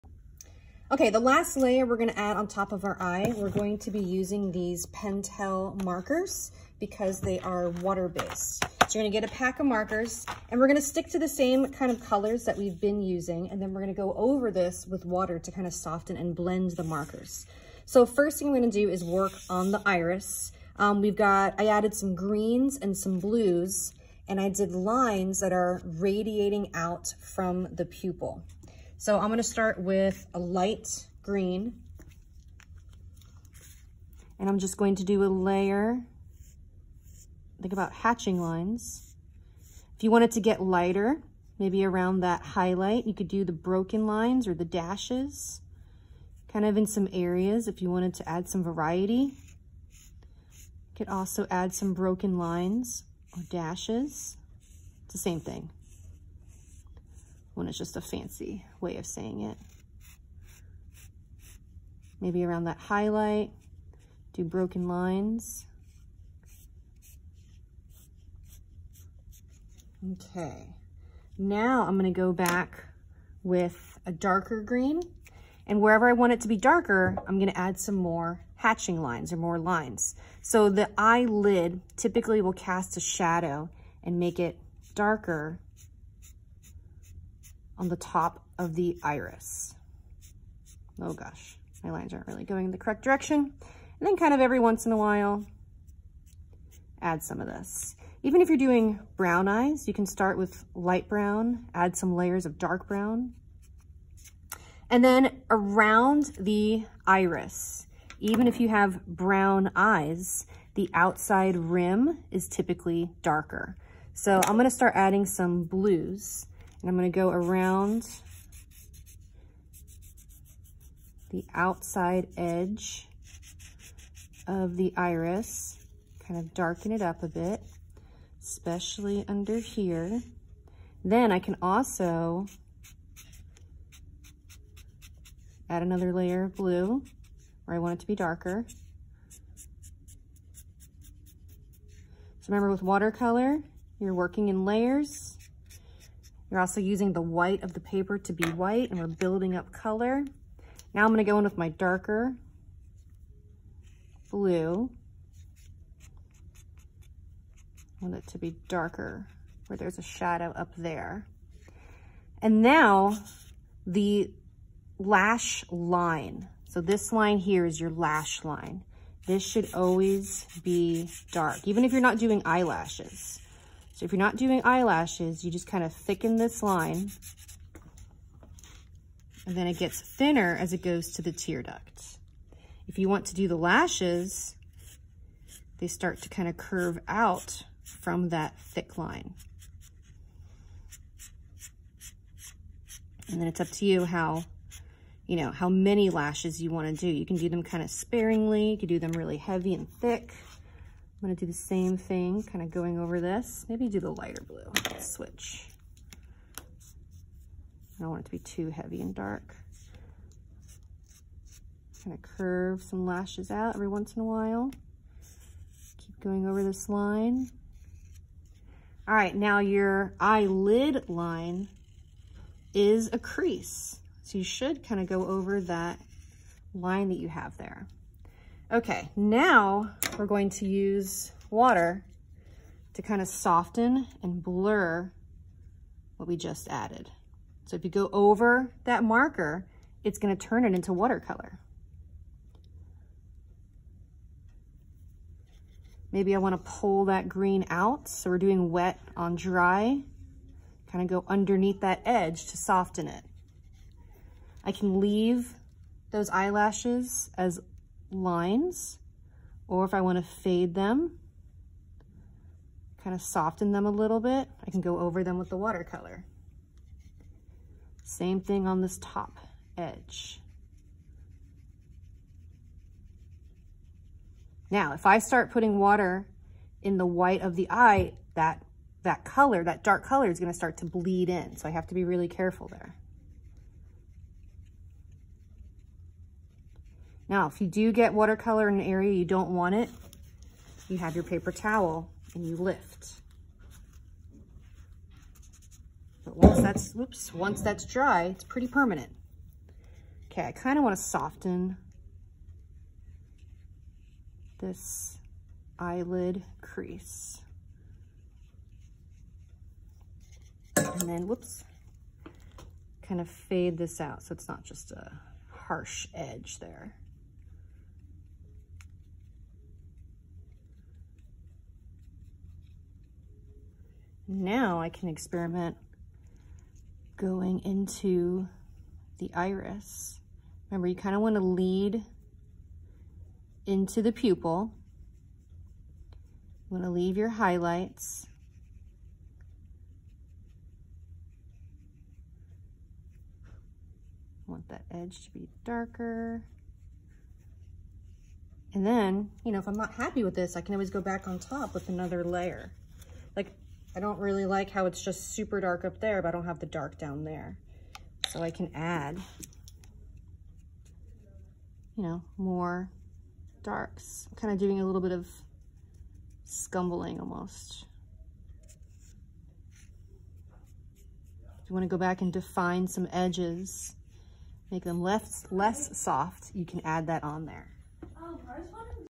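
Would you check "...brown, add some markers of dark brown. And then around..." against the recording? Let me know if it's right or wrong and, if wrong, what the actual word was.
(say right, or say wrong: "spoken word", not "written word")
wrong: "layers", not "markers".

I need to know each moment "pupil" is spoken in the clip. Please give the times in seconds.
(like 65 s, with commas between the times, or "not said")
27 s, 334 s.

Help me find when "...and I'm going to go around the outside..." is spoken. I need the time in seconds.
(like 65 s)
116 s.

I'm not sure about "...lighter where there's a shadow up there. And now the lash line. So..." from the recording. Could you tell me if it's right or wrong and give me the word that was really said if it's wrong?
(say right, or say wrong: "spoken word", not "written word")
wrong: "darker", not "lighter".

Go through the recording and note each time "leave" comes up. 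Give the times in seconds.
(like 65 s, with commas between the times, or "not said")
255 s, 336 s.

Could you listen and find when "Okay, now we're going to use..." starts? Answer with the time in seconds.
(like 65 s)
228 s.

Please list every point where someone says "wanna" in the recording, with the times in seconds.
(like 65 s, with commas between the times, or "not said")
246 s.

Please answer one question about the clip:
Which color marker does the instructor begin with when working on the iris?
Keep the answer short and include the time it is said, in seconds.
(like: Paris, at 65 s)
light green, at 30 s.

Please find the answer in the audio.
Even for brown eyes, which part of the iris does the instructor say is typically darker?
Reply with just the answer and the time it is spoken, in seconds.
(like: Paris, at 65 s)
the outside rim, at 110 s.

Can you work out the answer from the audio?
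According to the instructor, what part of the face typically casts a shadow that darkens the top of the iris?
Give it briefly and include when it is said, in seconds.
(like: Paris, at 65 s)
the eyelid, at 80 s.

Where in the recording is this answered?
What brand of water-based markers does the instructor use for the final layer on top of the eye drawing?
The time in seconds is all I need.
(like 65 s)
4 s.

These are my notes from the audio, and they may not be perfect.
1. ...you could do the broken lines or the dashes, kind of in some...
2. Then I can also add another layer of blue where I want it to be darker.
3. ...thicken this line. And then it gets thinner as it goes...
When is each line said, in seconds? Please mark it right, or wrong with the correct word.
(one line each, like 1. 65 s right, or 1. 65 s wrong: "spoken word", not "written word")
1. 43 s right
2. 131 s right
3. 175 s right.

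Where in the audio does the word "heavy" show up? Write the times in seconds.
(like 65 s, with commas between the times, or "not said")
199 s, 208 s.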